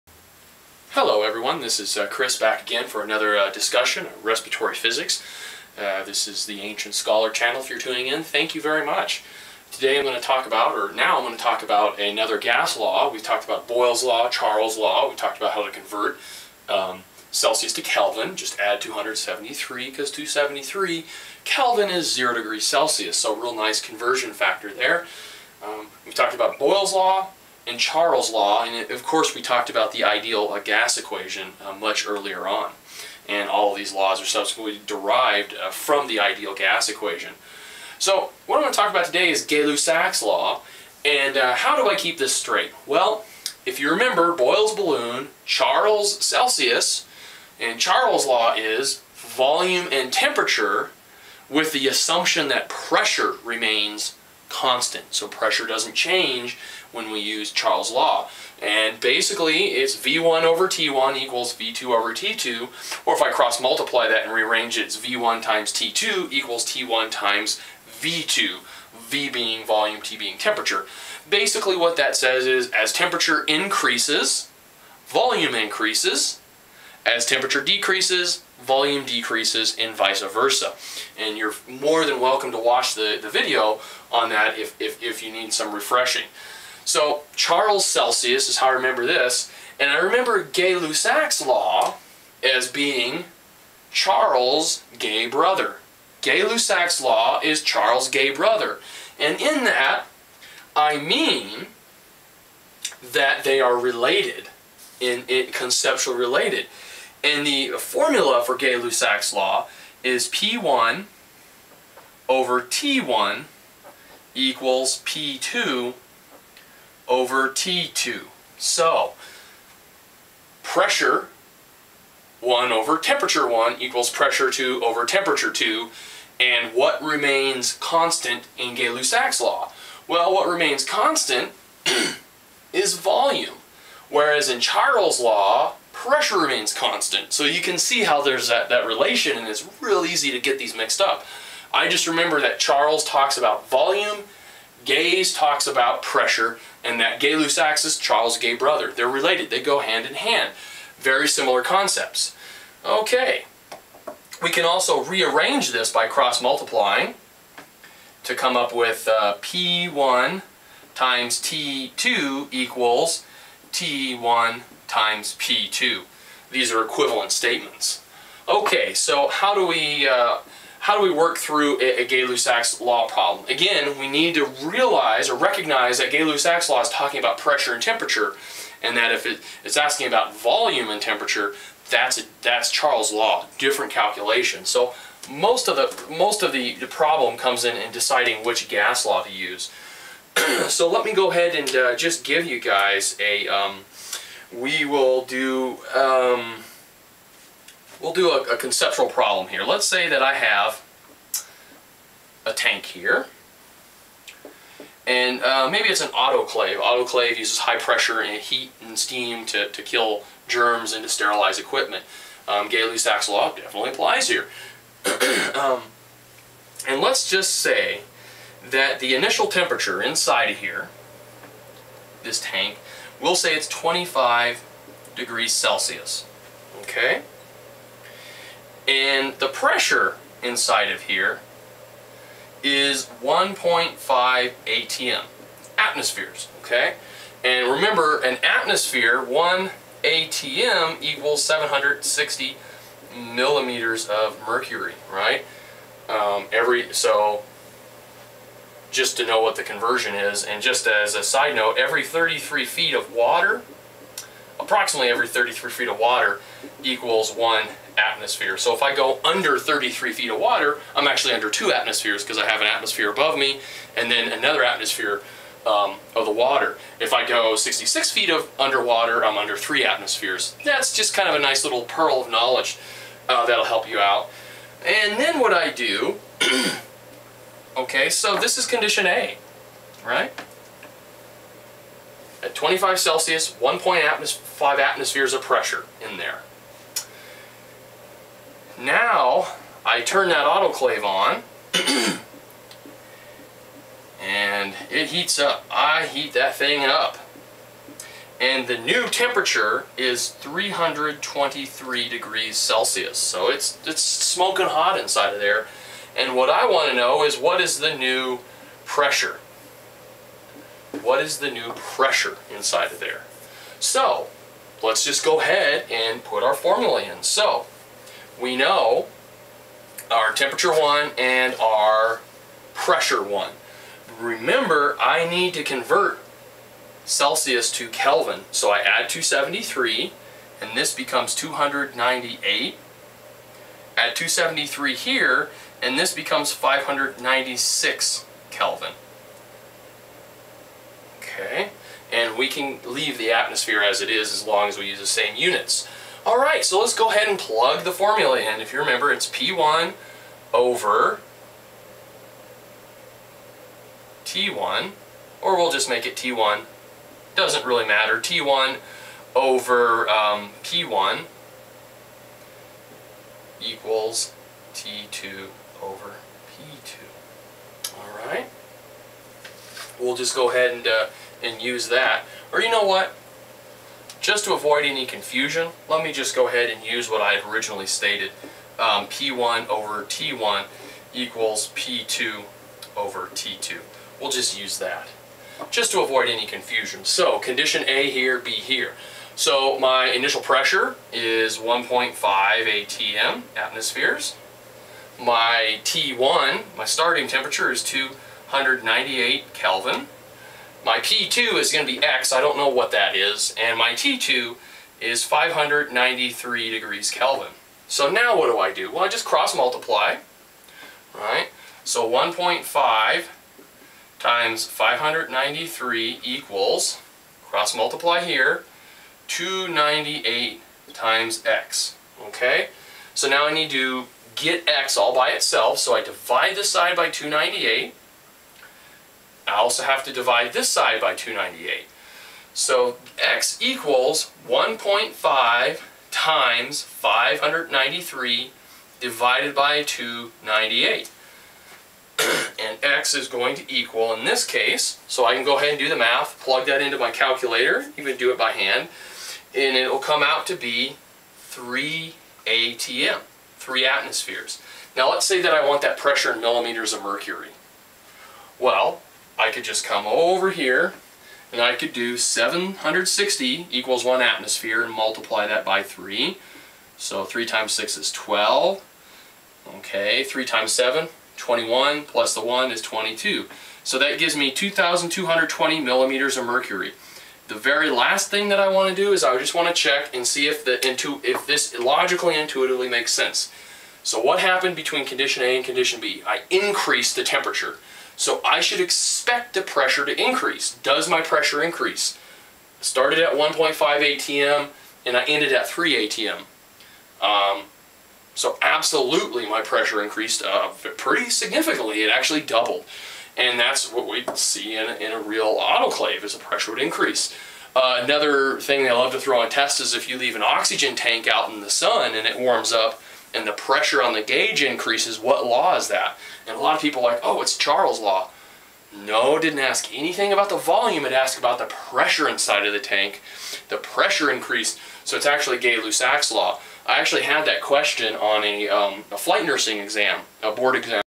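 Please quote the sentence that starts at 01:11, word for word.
Basically what that says is as temperature increases, volume increases.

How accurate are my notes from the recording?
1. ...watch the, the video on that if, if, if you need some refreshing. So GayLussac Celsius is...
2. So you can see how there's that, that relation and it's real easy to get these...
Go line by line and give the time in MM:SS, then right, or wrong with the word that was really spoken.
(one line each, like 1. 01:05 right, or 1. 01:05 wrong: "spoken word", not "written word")
1. 01:22 wrong: "Charles", not "GayLussac"
2. 02:17 right.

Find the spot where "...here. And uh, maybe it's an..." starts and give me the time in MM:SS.
03:22.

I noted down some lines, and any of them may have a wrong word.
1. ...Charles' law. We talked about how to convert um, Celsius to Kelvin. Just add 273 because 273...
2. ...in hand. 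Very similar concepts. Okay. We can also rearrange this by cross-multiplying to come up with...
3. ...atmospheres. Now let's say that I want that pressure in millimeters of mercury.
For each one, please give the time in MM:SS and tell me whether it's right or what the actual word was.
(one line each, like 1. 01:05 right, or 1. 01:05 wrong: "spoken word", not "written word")
1. 00:14 right
2. 02:30 right
3. 07:33 right.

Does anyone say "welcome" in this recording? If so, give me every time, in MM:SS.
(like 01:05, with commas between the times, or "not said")
01:22.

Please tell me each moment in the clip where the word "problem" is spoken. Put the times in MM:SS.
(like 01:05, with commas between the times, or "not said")
02:53, 03:06, 03:19.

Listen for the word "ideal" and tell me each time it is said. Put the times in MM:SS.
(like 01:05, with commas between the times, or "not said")
00:30, 00:36.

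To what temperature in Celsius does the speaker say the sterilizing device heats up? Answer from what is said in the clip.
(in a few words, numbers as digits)
323 degrees Celsius.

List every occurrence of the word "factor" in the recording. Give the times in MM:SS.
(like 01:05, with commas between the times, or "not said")
00:24.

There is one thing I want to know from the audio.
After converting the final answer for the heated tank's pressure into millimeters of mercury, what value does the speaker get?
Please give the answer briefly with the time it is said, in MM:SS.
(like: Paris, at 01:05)
2,220 millimeters of mercury, at 07:54.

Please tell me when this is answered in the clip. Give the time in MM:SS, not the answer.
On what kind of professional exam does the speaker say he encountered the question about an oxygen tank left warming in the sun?
08:49.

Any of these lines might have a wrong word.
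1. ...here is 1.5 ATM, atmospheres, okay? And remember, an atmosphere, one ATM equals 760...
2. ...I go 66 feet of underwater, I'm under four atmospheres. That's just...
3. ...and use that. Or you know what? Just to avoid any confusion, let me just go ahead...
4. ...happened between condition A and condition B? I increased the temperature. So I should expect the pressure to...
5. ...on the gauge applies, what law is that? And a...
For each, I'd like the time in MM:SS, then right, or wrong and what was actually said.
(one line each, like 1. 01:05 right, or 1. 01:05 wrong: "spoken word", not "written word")
1. 03:51 right
2. 04:27 wrong: "three", not "four"
3. 06:11 right
4. 08:04 right
5. 08:34 wrong: "increases", not "applies".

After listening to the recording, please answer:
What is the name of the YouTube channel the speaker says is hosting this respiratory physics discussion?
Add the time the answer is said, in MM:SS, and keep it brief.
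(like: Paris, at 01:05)
Ancient Scholar, at 00:06.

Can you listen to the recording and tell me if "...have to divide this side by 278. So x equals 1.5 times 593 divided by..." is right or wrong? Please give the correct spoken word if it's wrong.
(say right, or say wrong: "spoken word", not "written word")
wrong: "298", not "278".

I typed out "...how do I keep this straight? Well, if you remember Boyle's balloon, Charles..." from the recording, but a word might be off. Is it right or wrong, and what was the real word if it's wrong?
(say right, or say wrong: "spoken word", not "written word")
right.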